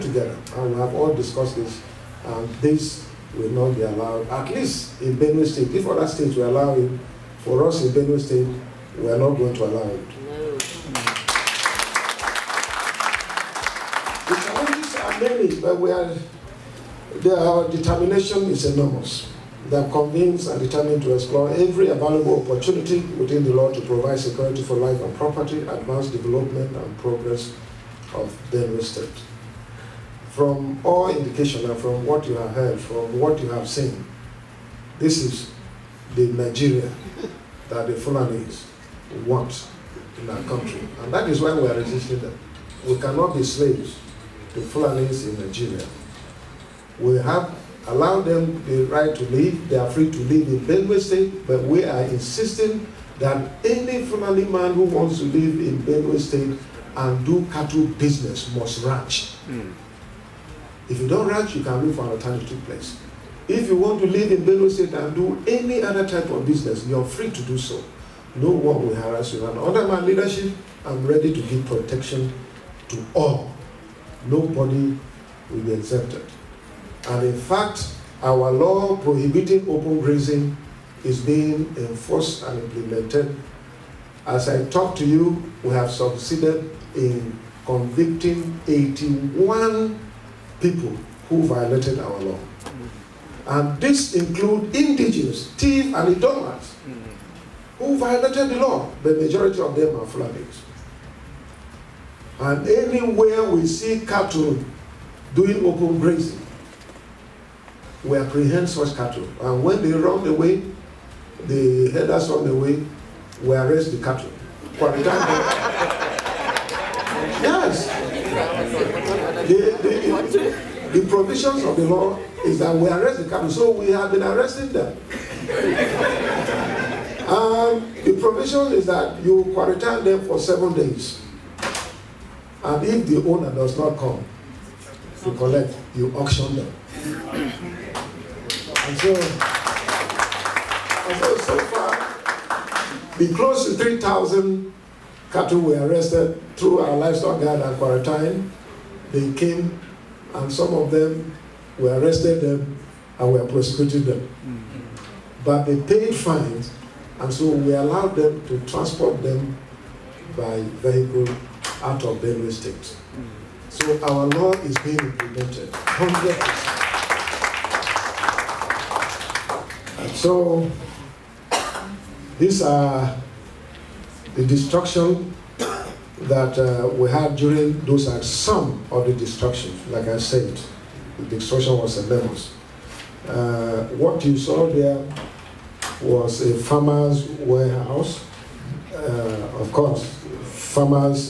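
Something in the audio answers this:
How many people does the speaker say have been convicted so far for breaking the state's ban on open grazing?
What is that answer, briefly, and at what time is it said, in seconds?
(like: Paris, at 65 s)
81, at 88 s.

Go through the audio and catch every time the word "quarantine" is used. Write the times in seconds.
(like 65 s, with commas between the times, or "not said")
129 s, 147 s.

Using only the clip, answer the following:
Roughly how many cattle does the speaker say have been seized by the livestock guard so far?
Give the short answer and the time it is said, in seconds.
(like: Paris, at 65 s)
3,000, at 143 s.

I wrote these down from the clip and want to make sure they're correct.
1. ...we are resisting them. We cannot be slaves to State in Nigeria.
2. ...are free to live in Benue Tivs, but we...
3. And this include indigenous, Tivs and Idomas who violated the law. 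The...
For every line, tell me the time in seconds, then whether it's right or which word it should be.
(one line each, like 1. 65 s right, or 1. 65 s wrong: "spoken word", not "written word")
1. 41 s wrong: "Fulanis", not "State"
2. 49 s wrong: "State", not "Tivs"
3. 93 s right.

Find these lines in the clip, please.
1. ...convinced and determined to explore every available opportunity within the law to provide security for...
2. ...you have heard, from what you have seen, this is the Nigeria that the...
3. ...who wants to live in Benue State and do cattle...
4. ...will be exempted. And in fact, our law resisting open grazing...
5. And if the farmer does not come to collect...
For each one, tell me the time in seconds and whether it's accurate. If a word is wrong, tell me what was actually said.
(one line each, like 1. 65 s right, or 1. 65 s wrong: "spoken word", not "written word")
1. 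19 s right
2. 32 s right
3. 54 s right
4. 75 s wrong: "prohibiting", not "resisting"
5. 132 s wrong: "owner", not "farmer".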